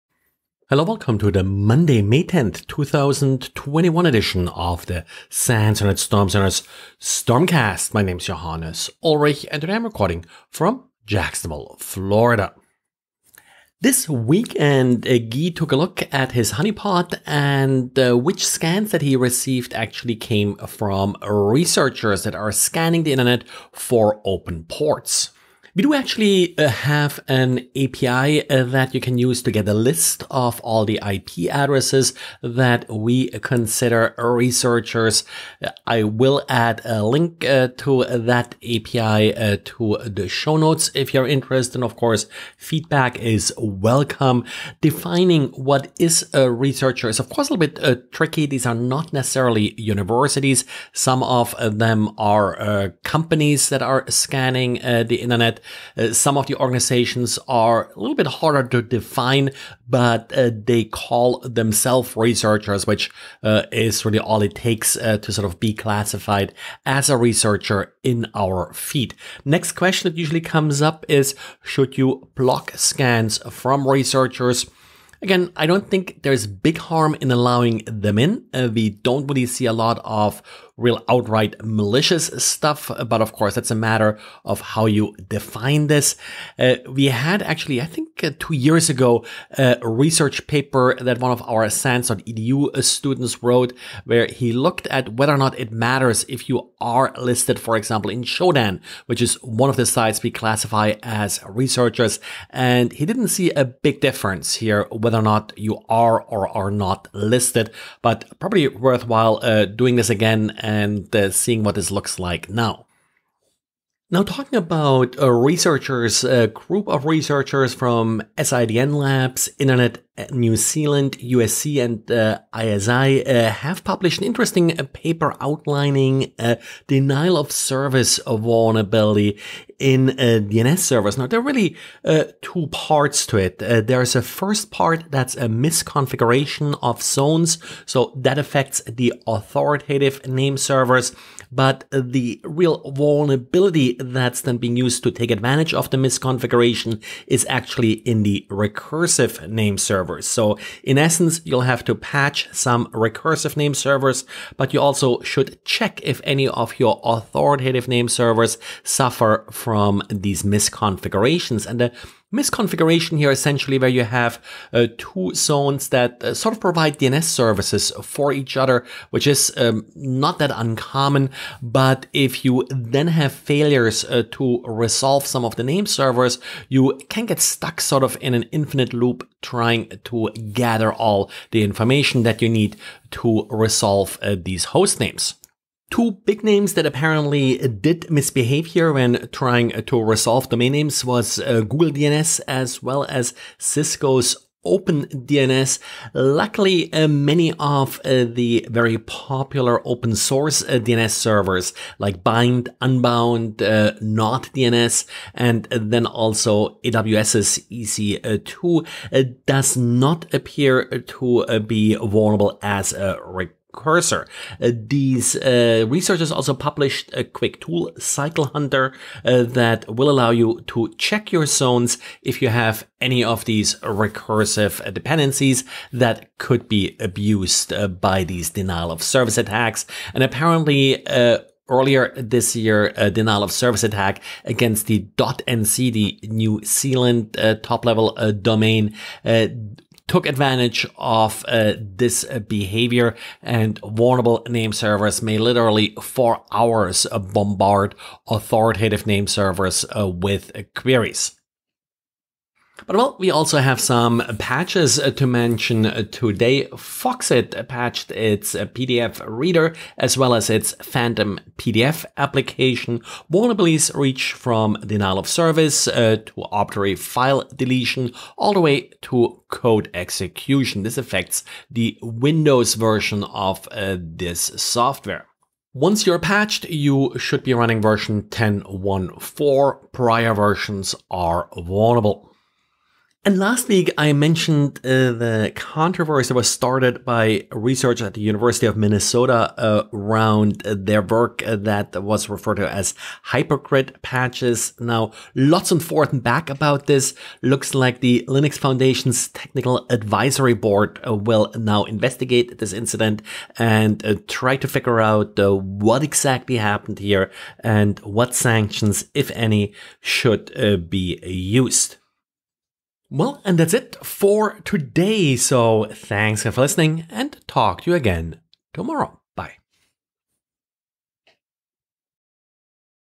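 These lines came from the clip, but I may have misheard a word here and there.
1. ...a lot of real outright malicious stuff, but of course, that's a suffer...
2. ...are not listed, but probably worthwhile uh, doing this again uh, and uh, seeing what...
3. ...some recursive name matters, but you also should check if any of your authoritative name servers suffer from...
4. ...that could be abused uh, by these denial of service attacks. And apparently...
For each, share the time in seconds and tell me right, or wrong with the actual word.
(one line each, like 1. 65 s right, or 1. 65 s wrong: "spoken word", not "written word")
1. 79 s wrong: "matter", not "suffer"
2. 106 s right
3. 152 s wrong: "servers", not "matters"
4. 225 s right.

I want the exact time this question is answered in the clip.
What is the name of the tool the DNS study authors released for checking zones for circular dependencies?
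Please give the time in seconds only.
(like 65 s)
217 s.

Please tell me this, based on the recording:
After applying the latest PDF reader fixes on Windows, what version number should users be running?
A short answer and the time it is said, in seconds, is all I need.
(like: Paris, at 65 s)
10.1.4, at 278 s.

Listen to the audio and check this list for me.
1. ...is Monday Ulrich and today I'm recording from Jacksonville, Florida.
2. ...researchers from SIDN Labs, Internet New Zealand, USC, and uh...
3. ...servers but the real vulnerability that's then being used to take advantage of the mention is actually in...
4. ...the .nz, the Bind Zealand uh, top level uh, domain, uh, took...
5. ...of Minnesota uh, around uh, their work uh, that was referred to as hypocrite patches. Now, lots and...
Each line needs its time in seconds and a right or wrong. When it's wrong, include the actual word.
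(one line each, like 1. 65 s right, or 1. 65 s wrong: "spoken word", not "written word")
1. 8 s wrong: "Johannes", not "Monday"
2. 117 s right
3. 140 s wrong: "misconfiguration", not "mention"
4. 234 s wrong: "New", not "Bind"
5. 288 s right.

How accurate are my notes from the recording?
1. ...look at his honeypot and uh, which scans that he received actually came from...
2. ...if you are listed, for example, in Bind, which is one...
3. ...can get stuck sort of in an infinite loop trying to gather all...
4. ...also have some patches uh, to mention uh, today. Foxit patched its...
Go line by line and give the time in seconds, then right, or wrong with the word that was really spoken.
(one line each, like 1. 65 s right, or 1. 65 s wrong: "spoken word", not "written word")
1. 15 s right
2. 96 s wrong: "Shodan", not "Bind"
3. 177 s right
4. 253 s right.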